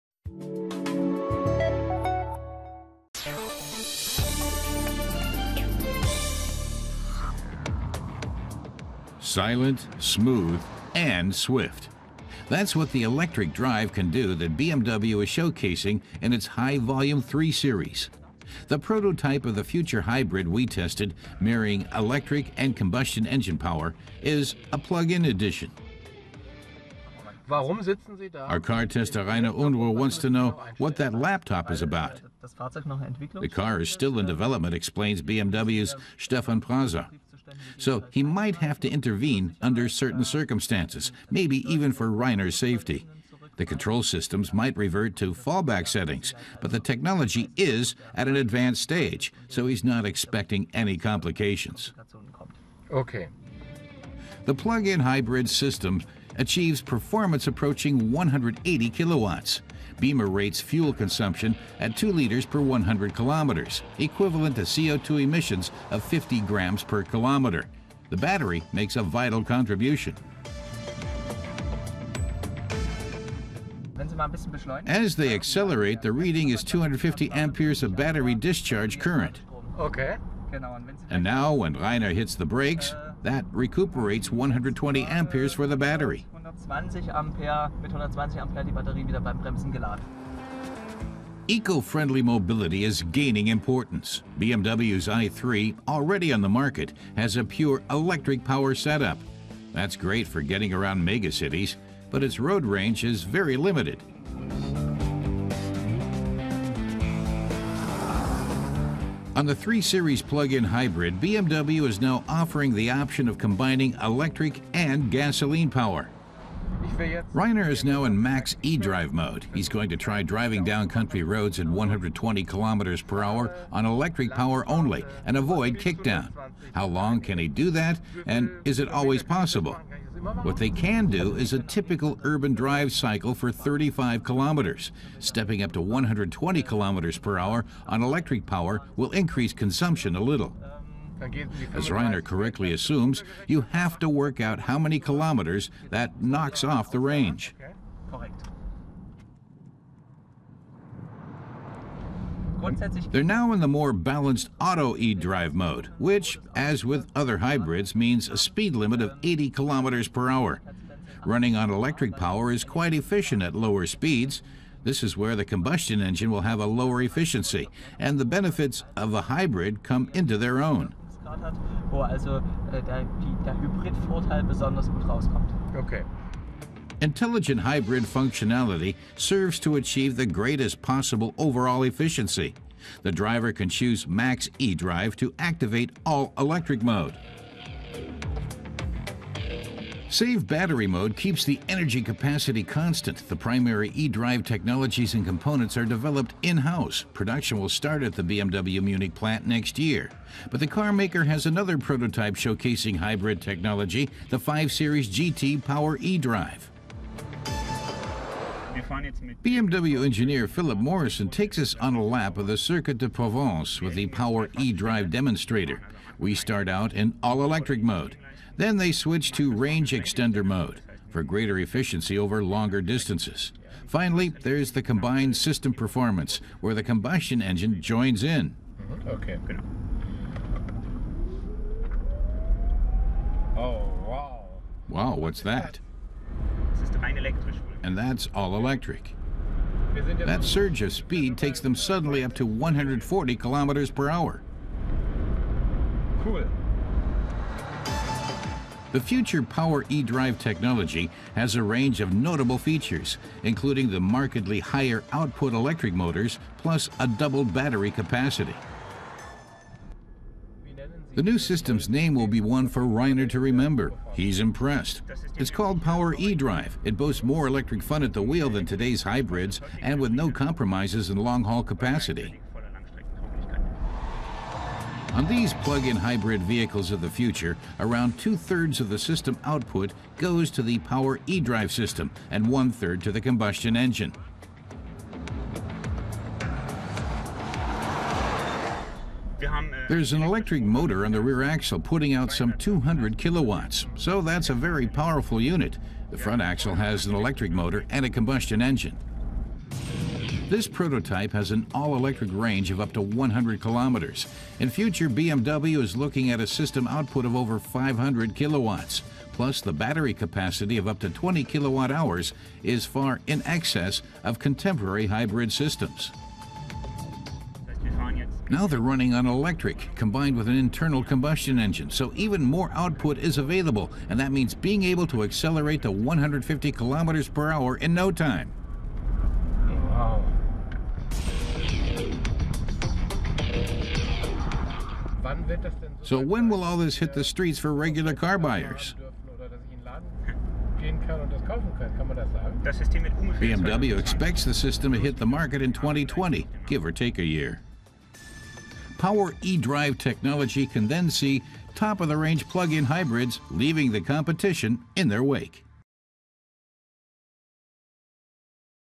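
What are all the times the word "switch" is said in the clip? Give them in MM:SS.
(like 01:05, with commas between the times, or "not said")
03:38.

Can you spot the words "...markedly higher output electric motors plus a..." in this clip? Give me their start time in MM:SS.
04:14.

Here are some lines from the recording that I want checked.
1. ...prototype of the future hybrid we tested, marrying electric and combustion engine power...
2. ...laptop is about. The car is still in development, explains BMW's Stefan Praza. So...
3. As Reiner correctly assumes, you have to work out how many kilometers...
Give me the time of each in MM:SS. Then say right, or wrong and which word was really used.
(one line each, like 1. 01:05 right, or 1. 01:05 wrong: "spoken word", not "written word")
1. 00:18 right
2. 00:31 right
3. 02:21 right.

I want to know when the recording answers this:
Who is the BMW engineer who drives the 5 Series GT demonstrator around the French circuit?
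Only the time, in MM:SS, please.
03:30.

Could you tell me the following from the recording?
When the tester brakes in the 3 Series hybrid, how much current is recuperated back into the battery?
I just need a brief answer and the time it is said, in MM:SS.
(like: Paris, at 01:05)
120 amperes, at 01:24.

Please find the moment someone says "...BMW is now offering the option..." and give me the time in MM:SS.
01:51.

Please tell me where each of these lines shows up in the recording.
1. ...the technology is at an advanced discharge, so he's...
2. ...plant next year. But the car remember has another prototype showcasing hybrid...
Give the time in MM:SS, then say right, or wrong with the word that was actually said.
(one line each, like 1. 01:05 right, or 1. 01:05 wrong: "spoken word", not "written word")
1. 00:46 wrong: "stage", not "discharge"
2. 03:19 wrong: "maker", not "remember".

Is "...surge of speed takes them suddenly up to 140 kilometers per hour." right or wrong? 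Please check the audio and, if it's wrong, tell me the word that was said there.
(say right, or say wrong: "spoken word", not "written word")
right.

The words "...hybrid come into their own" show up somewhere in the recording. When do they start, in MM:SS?
02:49.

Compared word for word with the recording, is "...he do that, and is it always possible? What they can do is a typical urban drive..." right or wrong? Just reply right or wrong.
right.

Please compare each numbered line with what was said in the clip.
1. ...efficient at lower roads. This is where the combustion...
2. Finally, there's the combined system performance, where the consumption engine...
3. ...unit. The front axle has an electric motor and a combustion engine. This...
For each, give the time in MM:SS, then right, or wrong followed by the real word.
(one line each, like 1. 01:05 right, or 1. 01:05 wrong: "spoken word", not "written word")
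1. 02:42 wrong: "speeds", not "roads"
2. 03:43 wrong: "combustion", not "consumption"
3. 04:55 right.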